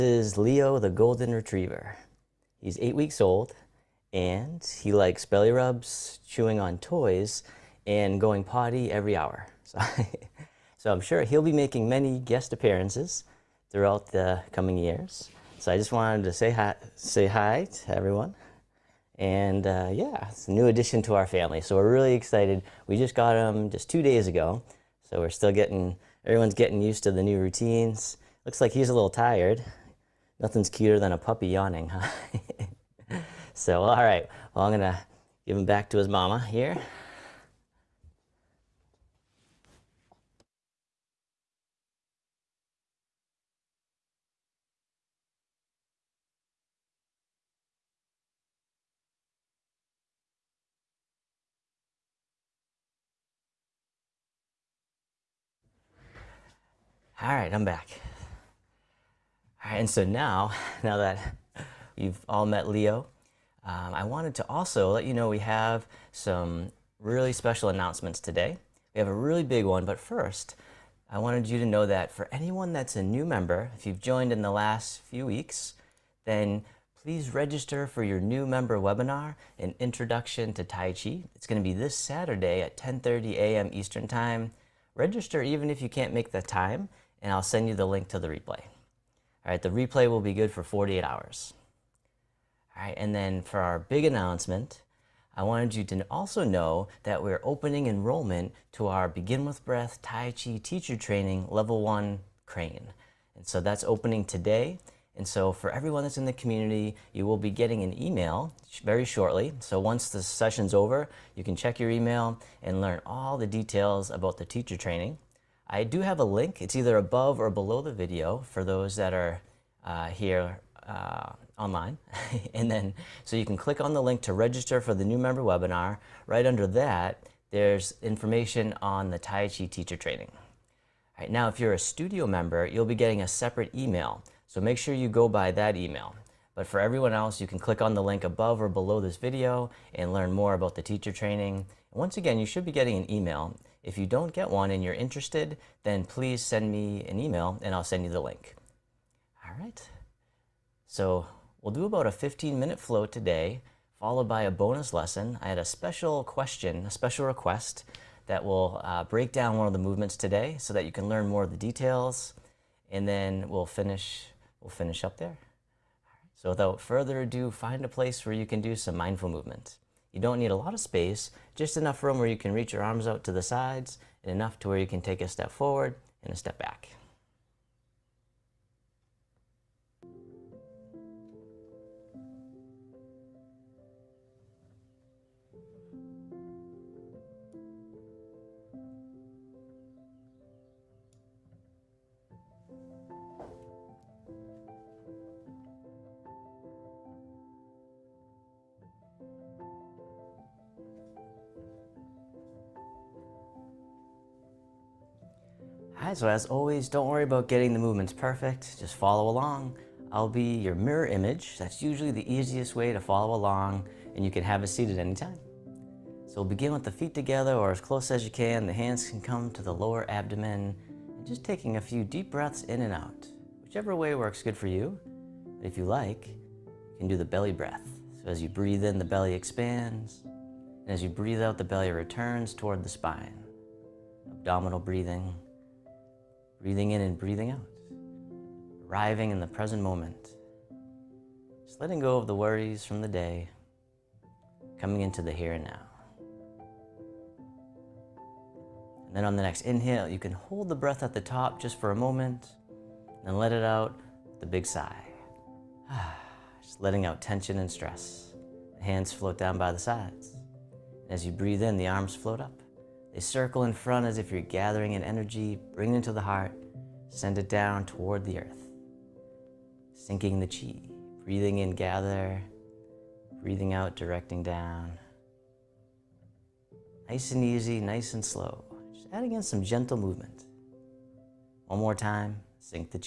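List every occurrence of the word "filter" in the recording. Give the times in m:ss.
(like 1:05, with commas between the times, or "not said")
not said.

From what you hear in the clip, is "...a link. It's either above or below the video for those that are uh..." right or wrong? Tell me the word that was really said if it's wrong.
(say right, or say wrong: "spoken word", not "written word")
right.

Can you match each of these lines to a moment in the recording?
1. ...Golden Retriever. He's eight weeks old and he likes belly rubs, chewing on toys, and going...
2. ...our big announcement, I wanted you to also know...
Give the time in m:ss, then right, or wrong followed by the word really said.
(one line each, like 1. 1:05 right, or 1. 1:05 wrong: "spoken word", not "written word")
1. 0:00 right
2. 1:33 right.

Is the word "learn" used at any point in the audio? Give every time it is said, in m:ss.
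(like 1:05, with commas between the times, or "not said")
1:52, 2:20, 2:41.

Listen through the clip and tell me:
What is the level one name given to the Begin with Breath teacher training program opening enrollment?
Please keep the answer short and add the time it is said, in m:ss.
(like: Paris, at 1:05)
crane, at 1:42.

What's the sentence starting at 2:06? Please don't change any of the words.
Right under that, there's information on the Tai Chi teacher training.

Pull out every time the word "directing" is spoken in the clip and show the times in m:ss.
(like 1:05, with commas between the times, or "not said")
4:33.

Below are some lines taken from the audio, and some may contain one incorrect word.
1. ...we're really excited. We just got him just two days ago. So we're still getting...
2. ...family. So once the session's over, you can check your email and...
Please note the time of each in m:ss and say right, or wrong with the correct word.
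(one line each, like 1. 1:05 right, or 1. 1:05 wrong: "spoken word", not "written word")
1. 0:21 right
2. 1:49 wrong: "shortly", not "family".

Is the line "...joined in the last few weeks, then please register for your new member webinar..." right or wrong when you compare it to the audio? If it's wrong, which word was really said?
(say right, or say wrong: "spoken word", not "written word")
right.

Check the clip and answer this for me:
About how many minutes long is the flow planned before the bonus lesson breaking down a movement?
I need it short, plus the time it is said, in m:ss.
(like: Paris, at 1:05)
15, at 2:32.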